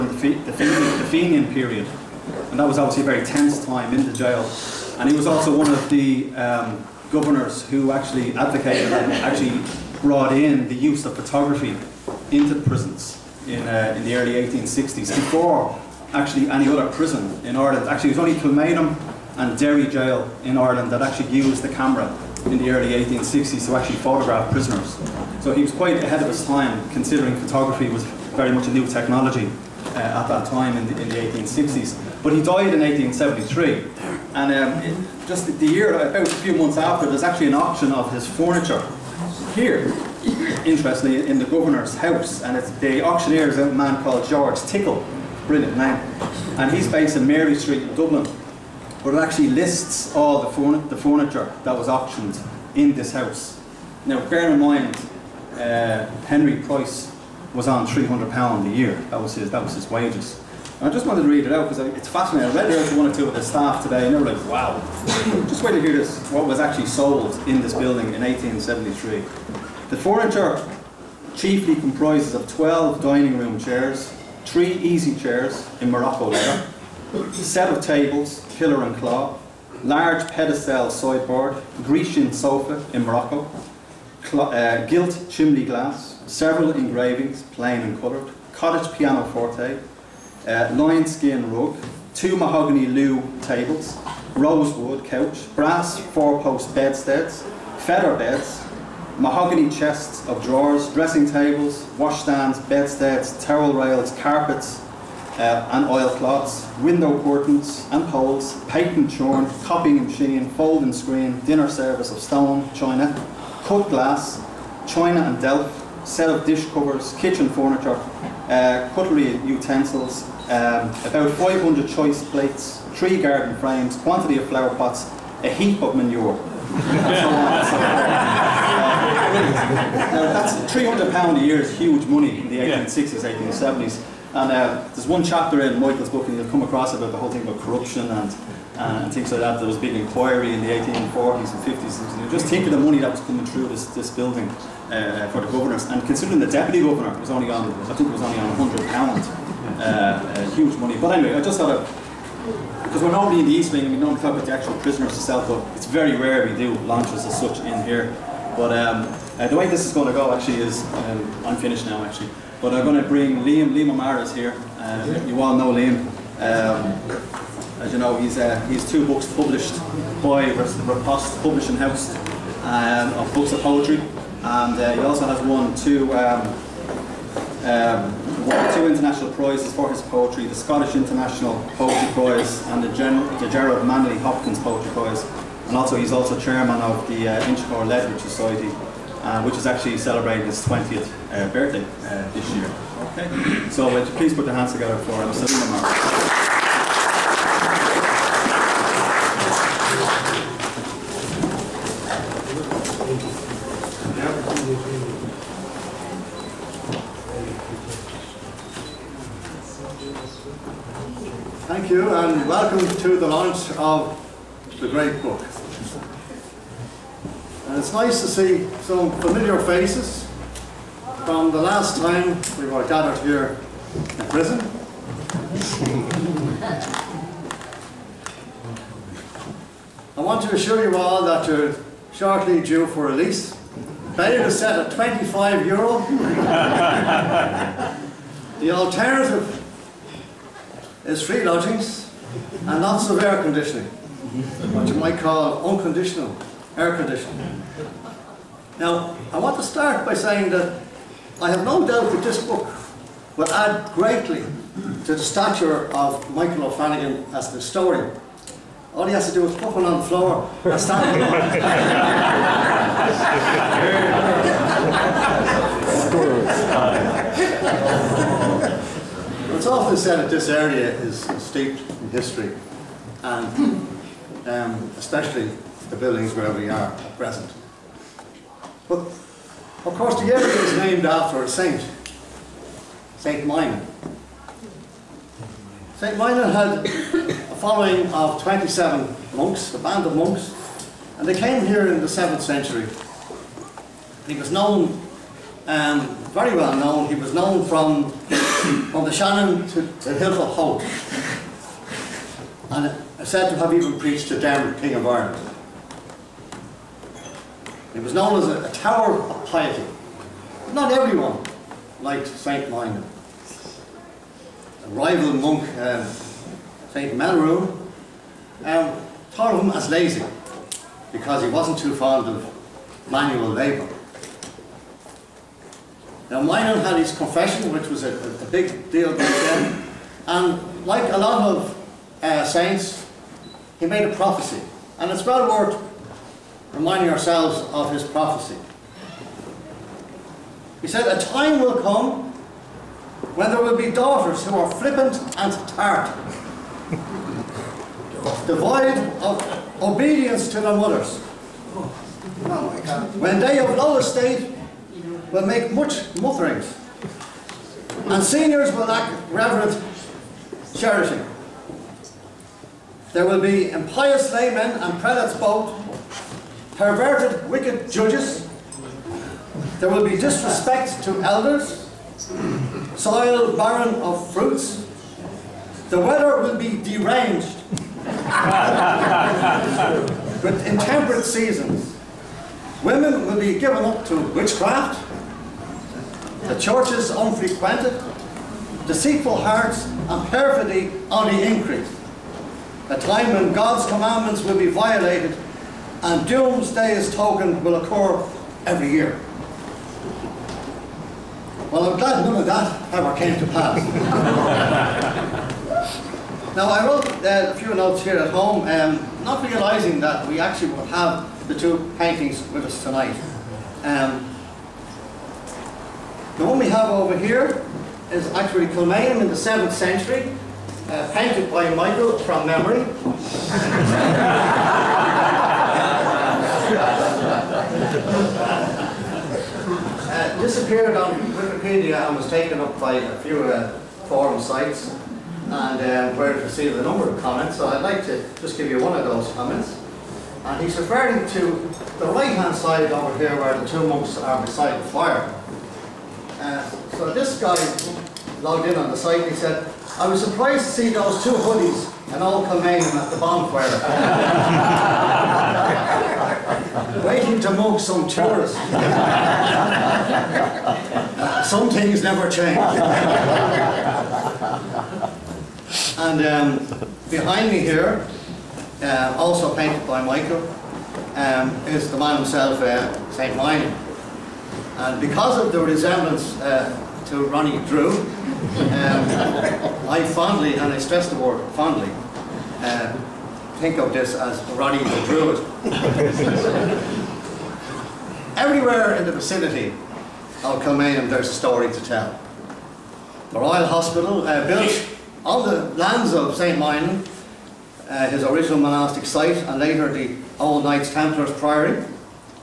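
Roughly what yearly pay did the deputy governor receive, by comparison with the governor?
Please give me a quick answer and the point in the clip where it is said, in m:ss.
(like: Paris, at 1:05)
100 pounds, at 2:28.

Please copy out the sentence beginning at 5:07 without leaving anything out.
It was known as a, a tower of piety.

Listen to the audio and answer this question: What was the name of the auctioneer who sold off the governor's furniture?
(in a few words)
George Tickle.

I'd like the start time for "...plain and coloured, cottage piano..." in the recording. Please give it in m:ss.
1:27.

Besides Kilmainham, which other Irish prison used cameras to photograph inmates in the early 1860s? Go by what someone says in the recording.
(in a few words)
Derry Jail.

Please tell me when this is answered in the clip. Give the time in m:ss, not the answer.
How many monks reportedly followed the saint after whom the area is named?
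4:48.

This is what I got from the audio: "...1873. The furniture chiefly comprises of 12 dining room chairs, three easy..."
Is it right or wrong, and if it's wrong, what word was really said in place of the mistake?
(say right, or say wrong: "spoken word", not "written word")
right.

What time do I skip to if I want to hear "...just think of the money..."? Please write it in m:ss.
2:22.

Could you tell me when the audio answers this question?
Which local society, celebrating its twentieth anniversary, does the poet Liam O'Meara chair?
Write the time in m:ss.
3:07.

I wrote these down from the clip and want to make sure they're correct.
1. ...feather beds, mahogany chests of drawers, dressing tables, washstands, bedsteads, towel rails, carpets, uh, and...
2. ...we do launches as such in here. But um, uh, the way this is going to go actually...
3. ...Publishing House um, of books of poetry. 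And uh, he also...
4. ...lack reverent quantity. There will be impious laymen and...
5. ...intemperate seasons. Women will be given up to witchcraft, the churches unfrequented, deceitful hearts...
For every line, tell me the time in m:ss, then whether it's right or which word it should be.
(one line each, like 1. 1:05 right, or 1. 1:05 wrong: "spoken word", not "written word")
1. 1:37 right
2. 2:36 right
3. 2:51 right
4. 5:58 wrong: "charity", not "quantity"
5. 6:20 right.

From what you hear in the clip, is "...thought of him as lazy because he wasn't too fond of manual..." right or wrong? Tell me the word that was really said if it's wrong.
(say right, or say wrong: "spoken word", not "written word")
right.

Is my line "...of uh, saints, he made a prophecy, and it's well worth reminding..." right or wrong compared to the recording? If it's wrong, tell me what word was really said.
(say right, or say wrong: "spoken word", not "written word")
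right.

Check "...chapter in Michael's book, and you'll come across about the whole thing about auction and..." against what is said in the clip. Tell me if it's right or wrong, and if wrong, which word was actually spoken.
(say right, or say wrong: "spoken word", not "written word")
wrong: "corruption", not "auction".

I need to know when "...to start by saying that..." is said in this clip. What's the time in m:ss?
4:09.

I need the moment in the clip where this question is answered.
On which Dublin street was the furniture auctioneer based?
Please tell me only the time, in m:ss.
0:47.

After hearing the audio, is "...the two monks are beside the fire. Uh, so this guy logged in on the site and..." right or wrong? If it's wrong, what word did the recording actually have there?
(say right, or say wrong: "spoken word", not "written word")
right.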